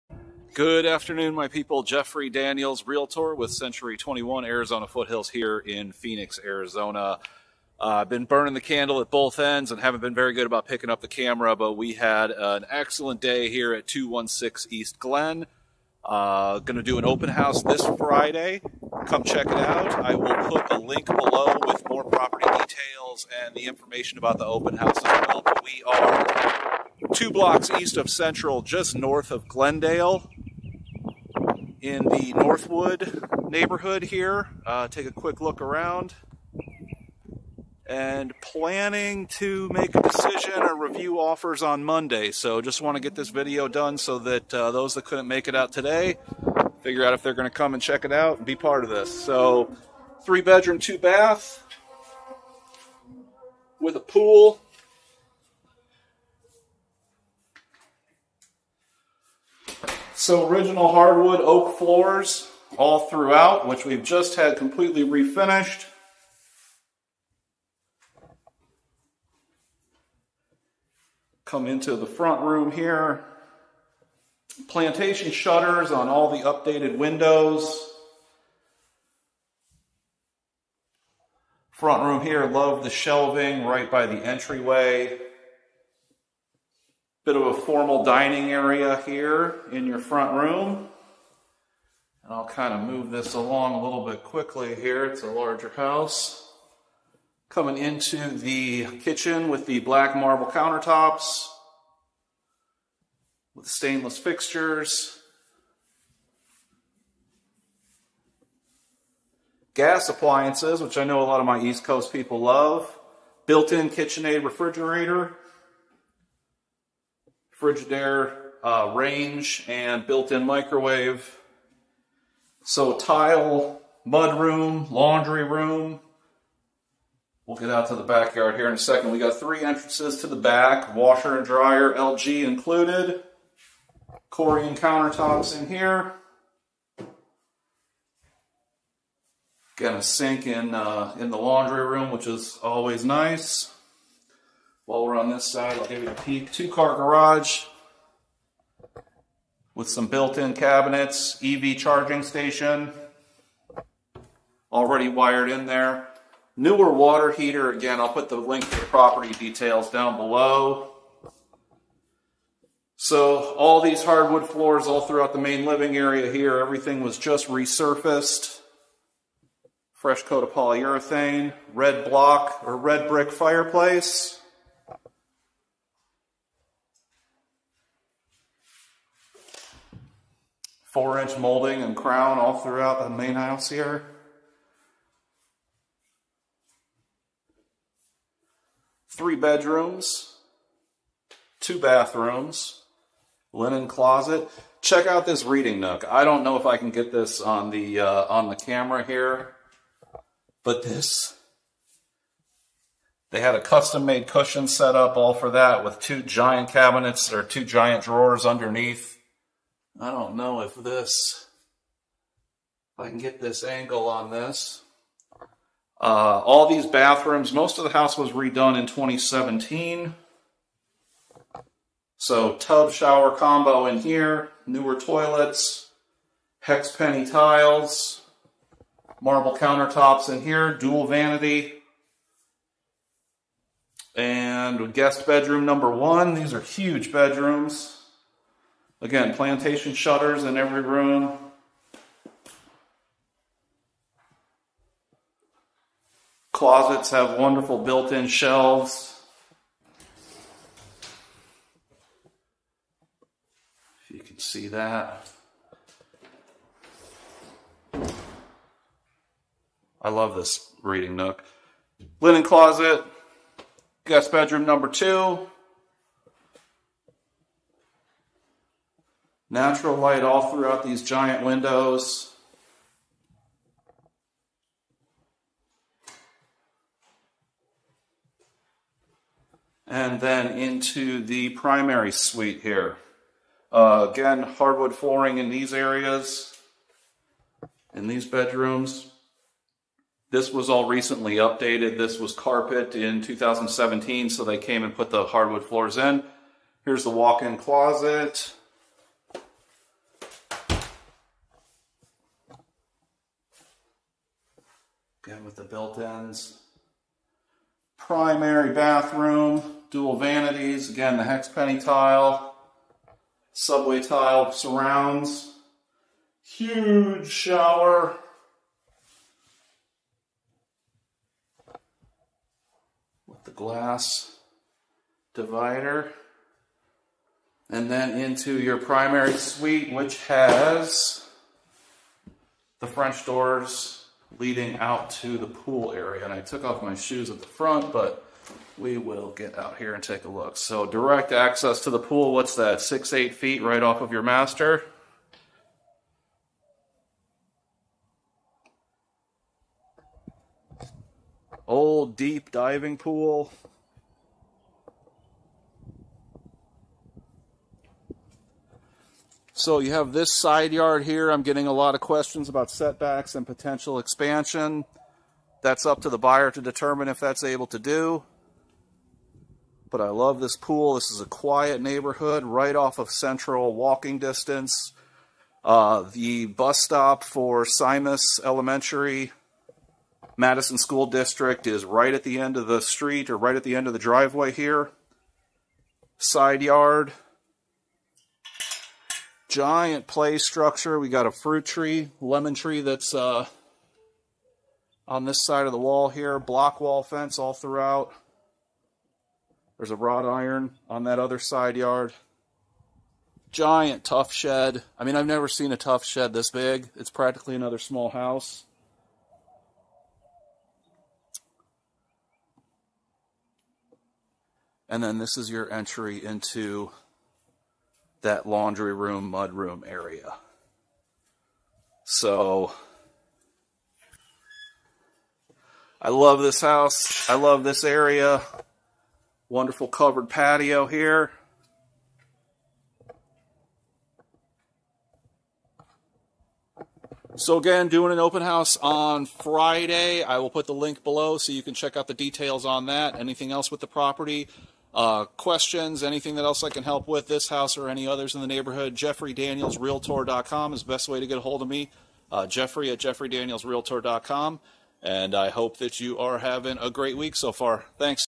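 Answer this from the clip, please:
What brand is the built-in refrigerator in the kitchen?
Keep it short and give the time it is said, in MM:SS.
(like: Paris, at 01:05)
KitchenAid, at 01:53.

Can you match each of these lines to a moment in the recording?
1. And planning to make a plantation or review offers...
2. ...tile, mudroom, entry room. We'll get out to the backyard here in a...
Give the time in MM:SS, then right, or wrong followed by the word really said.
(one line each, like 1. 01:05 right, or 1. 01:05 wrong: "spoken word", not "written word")
1. 00:37 wrong: "decision", not "plantation"
2. 02:02 wrong: "laundry", not "entry".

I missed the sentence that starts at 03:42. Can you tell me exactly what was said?
So tub shower combo in here, newer toilets, hex penny tiles, marble countertops in here, dual vanity, and guest bedroom number one.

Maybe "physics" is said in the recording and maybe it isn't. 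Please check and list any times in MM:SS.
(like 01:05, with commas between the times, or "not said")
not said.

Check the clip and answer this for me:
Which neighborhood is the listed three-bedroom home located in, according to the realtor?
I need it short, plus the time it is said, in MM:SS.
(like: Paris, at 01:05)
Northwood, at 00:32.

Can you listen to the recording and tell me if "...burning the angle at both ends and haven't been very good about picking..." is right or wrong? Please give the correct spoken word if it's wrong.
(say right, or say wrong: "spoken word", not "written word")
wrong: "candle", not "angle".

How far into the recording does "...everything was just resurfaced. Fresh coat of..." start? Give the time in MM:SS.
02:46.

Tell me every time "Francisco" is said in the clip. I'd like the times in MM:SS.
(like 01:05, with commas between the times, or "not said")
not said.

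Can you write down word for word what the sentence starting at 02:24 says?
While we're on this side, I'll give you a peek.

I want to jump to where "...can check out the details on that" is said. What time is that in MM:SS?
07:21.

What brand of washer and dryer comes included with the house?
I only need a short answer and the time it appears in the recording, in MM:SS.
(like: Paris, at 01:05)
LG, at 02:11.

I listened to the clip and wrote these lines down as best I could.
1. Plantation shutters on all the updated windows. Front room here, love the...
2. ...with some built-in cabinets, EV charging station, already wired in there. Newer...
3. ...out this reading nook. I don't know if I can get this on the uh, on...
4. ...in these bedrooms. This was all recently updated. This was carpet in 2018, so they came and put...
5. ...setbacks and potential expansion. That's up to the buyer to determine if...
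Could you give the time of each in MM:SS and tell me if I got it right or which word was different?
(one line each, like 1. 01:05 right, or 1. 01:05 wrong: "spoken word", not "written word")
1. 01:14 right
2. 02:29 right
3. 03:15 right
4. 04:47 wrong: "2017", not "2018"
5. 06:02 right.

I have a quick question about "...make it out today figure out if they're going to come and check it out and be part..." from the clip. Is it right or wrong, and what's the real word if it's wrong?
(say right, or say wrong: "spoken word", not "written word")
right.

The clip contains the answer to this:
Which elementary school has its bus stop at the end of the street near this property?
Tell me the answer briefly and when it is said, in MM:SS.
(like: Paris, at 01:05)
Simis Elementary, at 06:17.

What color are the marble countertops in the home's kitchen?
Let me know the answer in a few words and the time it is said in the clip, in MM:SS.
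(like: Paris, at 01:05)
Black, at 01:39.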